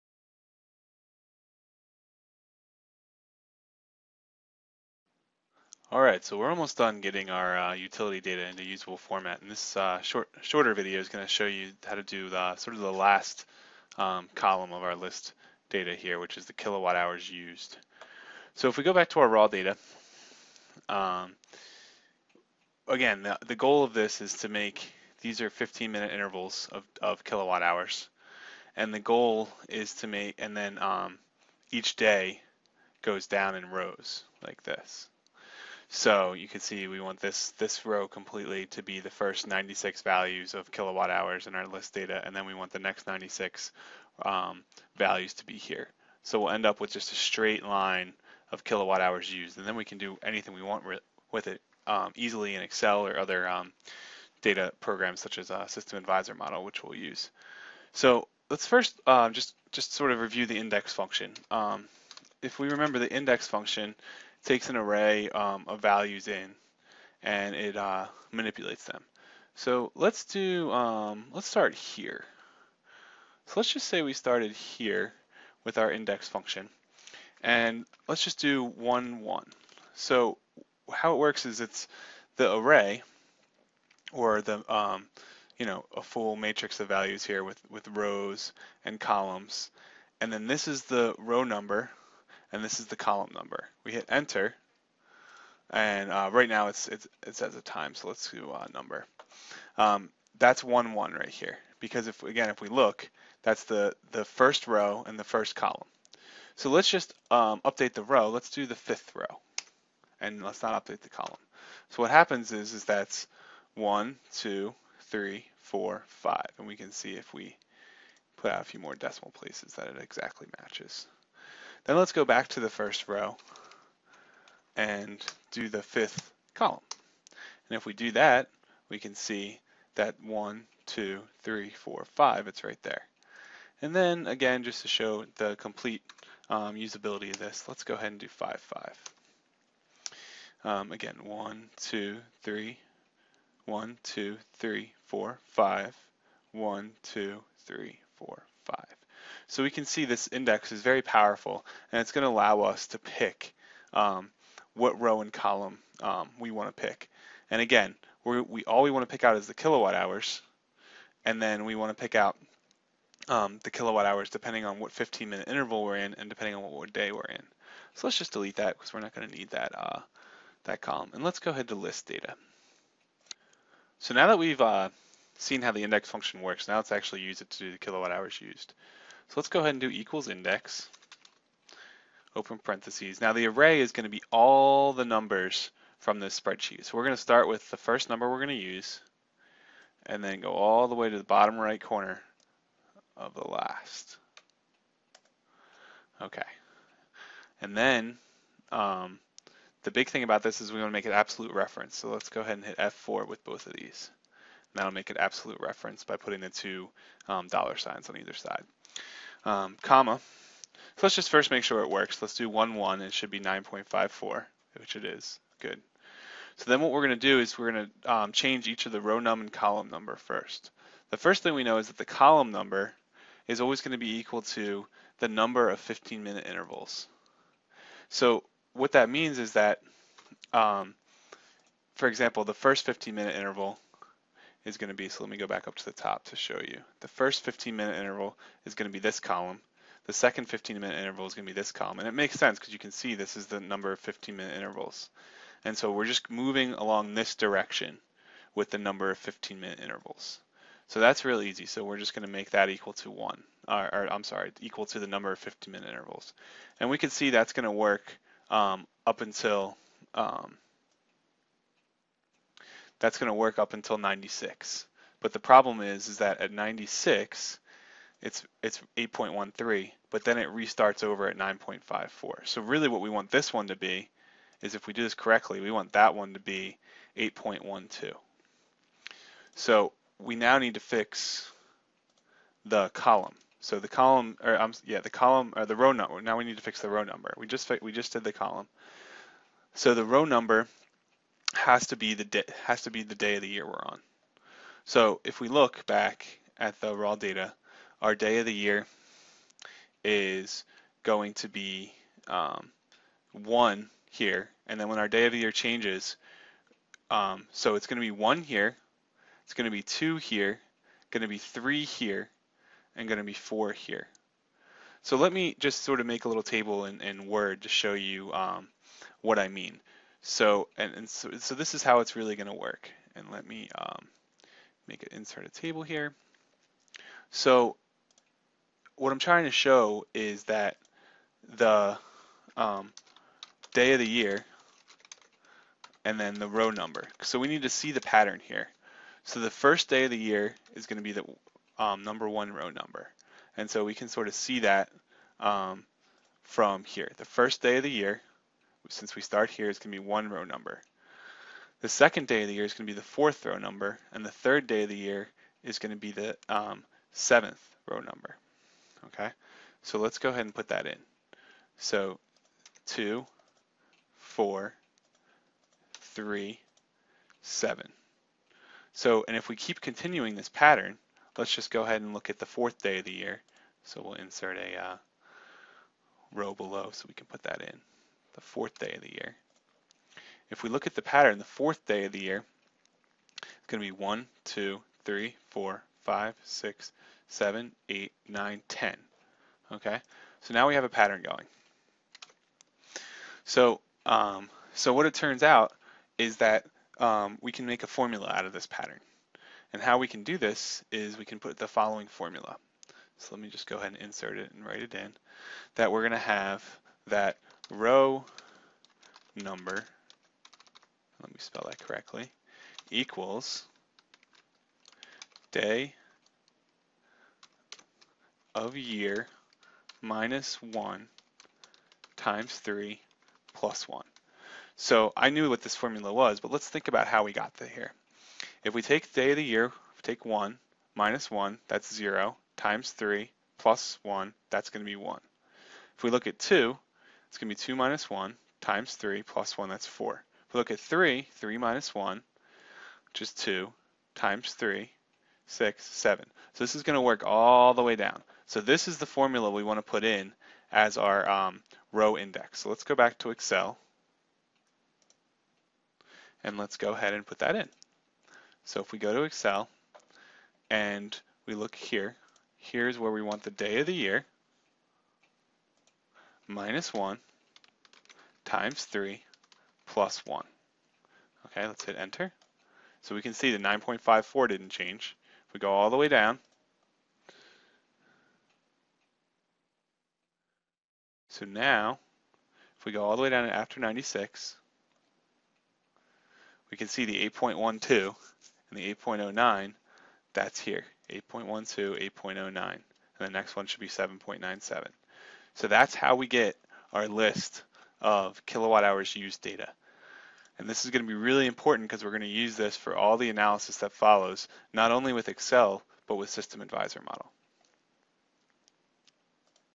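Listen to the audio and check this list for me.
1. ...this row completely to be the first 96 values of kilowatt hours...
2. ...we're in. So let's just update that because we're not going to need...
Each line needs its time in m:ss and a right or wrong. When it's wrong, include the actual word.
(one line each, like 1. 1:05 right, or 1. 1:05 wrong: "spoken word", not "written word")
1. 0:37 right
2. 2:47 wrong: "delete", not "update".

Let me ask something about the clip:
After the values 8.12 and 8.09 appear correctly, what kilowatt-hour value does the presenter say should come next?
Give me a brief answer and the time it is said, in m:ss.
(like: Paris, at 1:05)
7.97, at 8:13.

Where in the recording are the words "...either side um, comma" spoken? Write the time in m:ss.
3:28.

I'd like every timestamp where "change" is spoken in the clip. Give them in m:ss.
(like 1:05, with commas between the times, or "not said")
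3:38, 5:05, 7:54.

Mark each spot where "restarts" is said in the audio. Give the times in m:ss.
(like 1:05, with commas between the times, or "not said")
4:30.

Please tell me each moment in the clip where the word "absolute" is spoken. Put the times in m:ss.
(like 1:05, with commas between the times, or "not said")
3:21, 3:25.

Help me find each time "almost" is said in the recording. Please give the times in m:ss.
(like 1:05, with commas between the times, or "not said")
0:06.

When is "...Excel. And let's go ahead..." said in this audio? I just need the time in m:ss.
7:33.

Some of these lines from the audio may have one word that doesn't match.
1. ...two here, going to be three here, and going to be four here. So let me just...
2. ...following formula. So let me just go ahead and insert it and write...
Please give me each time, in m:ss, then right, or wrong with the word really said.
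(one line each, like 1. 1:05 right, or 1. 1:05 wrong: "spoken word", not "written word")
1. 5:09 right
2. 6:41 right.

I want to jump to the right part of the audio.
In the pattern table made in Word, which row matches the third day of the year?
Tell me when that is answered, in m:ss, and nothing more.
5:57.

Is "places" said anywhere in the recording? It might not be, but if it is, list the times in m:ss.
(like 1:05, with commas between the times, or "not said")
1:59.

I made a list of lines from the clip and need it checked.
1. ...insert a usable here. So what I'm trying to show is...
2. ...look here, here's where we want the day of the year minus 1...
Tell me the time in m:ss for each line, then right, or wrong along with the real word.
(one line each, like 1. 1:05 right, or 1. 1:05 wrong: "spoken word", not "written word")
1. 5:25 wrong: "table", not "usable"
2. 7:41 right.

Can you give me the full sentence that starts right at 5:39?
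So the first day of the year is going to be the um, number one row number.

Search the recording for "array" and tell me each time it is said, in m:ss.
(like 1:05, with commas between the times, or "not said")
1:04, 1:22, 3:03.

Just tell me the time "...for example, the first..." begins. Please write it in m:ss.
3:51.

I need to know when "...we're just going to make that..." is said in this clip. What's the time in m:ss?
4:11.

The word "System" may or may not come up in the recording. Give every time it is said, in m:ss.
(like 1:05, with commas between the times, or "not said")
0:55, 8:26.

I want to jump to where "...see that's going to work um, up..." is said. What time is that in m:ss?
4:17.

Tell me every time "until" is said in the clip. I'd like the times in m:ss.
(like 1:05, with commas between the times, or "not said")
4:19, 4:23.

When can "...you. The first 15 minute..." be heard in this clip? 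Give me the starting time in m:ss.
3:56.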